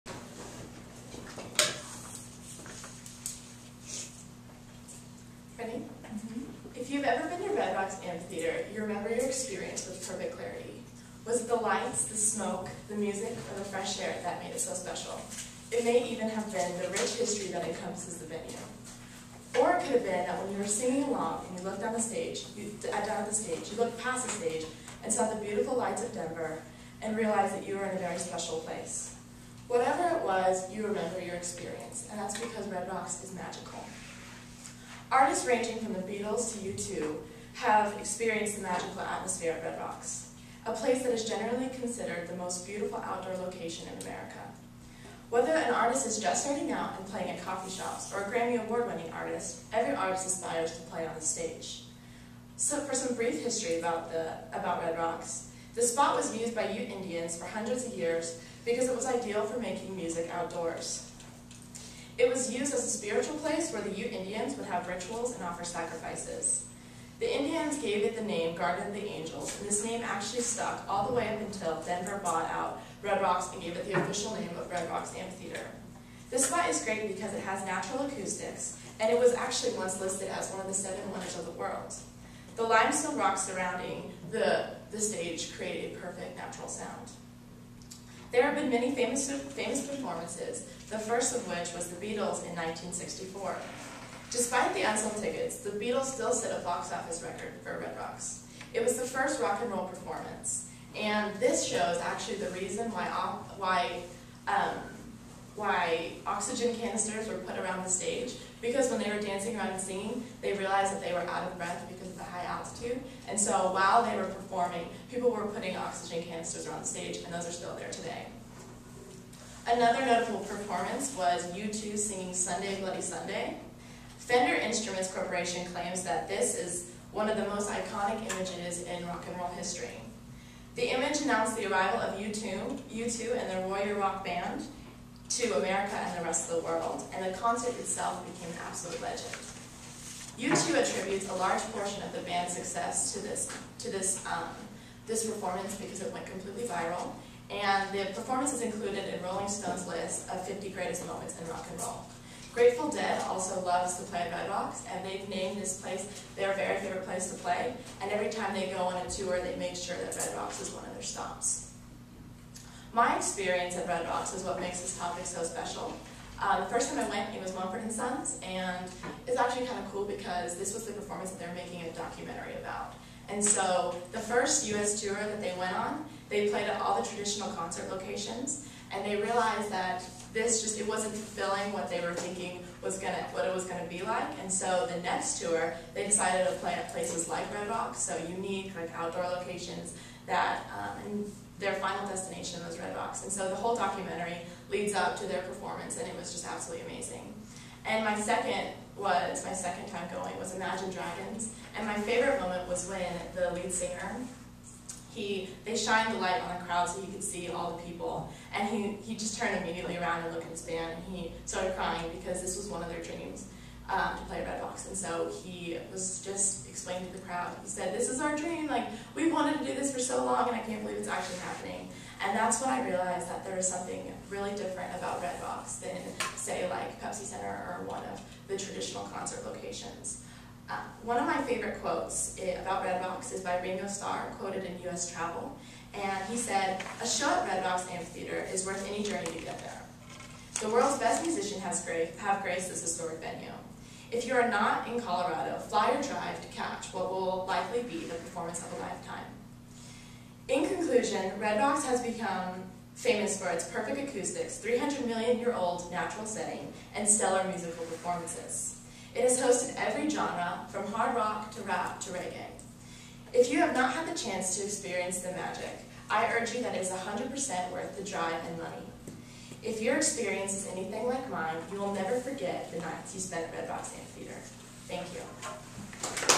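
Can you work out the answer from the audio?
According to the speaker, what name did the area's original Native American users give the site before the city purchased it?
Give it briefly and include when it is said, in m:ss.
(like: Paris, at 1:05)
Garden of the Angels, at 1:08.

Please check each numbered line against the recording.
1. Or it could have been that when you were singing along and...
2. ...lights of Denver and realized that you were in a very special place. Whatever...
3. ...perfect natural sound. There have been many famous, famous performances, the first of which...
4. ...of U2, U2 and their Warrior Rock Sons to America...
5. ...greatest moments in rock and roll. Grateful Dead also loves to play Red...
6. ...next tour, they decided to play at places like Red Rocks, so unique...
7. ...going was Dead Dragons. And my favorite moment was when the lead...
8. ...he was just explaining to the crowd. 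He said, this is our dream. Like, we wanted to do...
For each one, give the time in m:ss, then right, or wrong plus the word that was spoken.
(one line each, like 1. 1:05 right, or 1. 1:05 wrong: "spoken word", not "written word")
1. 0:19 right
2. 0:25 right
3. 1:25 right
4. 2:11 wrong: "Band", not "Sons"
5. 2:30 right
6. 3:05 right
7. 3:20 wrong: "Imagine", not "Dead"
8. 3:35 right.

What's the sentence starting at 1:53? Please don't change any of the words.
And so while they were performing, people were putting oxygen canisters on stage, and those are still there today.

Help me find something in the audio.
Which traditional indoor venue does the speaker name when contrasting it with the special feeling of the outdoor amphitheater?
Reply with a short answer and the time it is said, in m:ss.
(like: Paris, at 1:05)
Pepsi Center, at 3:47.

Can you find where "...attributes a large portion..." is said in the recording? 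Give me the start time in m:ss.
2:20.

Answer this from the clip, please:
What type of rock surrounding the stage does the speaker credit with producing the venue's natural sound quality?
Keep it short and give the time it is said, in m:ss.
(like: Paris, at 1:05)
Limestone, at 1:22.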